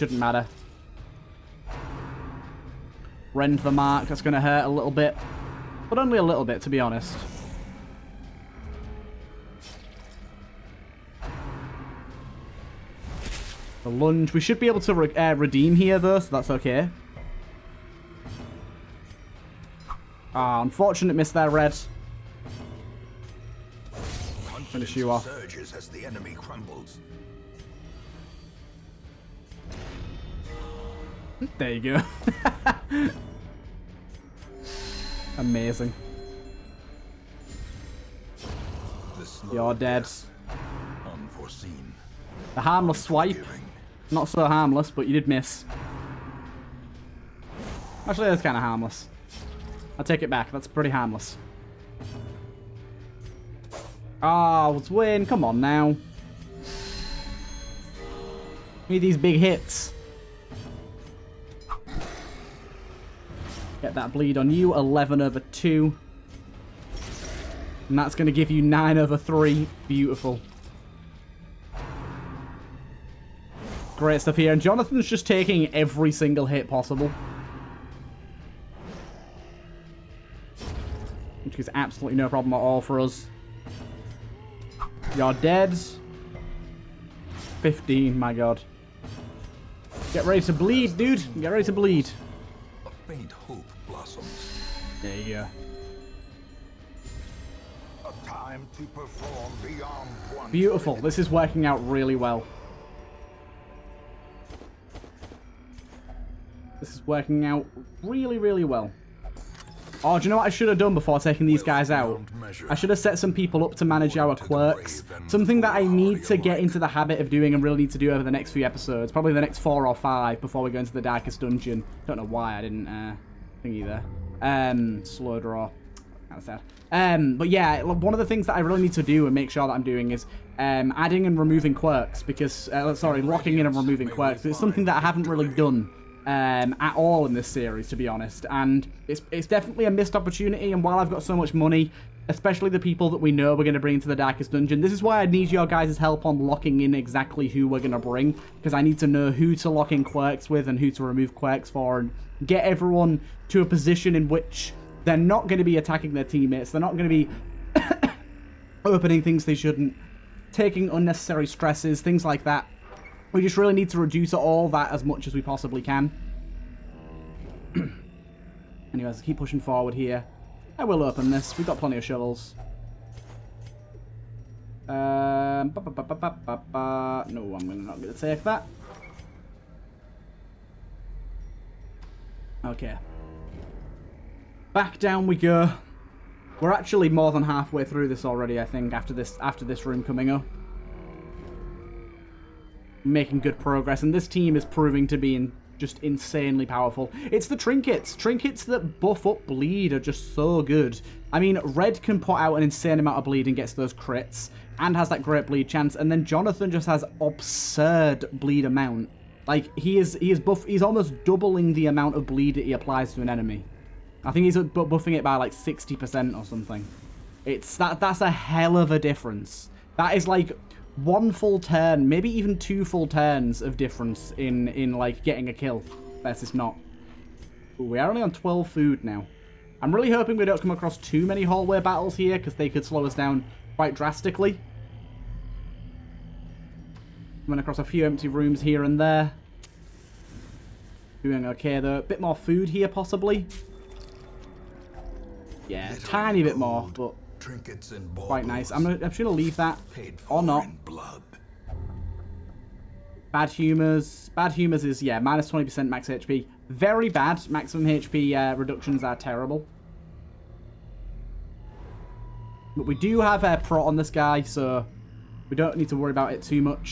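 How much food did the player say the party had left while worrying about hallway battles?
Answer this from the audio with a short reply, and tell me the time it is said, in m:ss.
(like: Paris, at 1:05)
12, at 3:48.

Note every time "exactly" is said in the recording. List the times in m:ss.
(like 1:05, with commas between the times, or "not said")
2:26.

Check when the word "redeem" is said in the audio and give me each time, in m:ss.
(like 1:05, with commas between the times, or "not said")
0:15.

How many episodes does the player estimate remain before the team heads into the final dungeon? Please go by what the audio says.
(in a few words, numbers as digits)
four or five.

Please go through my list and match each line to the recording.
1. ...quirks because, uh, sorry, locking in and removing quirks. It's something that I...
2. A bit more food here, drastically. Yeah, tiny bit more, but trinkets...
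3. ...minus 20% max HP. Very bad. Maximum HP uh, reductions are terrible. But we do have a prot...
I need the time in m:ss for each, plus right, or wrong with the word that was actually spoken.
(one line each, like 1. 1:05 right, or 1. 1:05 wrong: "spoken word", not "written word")
1. 2:11 right
2. 4:01 wrong: "possibly", not "drastically"
3. 4:15 right.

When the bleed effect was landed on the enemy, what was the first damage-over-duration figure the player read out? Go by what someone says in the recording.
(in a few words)
11 over 2.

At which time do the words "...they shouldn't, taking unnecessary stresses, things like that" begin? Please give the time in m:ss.
2:39.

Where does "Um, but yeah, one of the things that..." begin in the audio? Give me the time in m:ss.
2:06.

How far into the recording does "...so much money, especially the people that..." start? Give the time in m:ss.
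2:21.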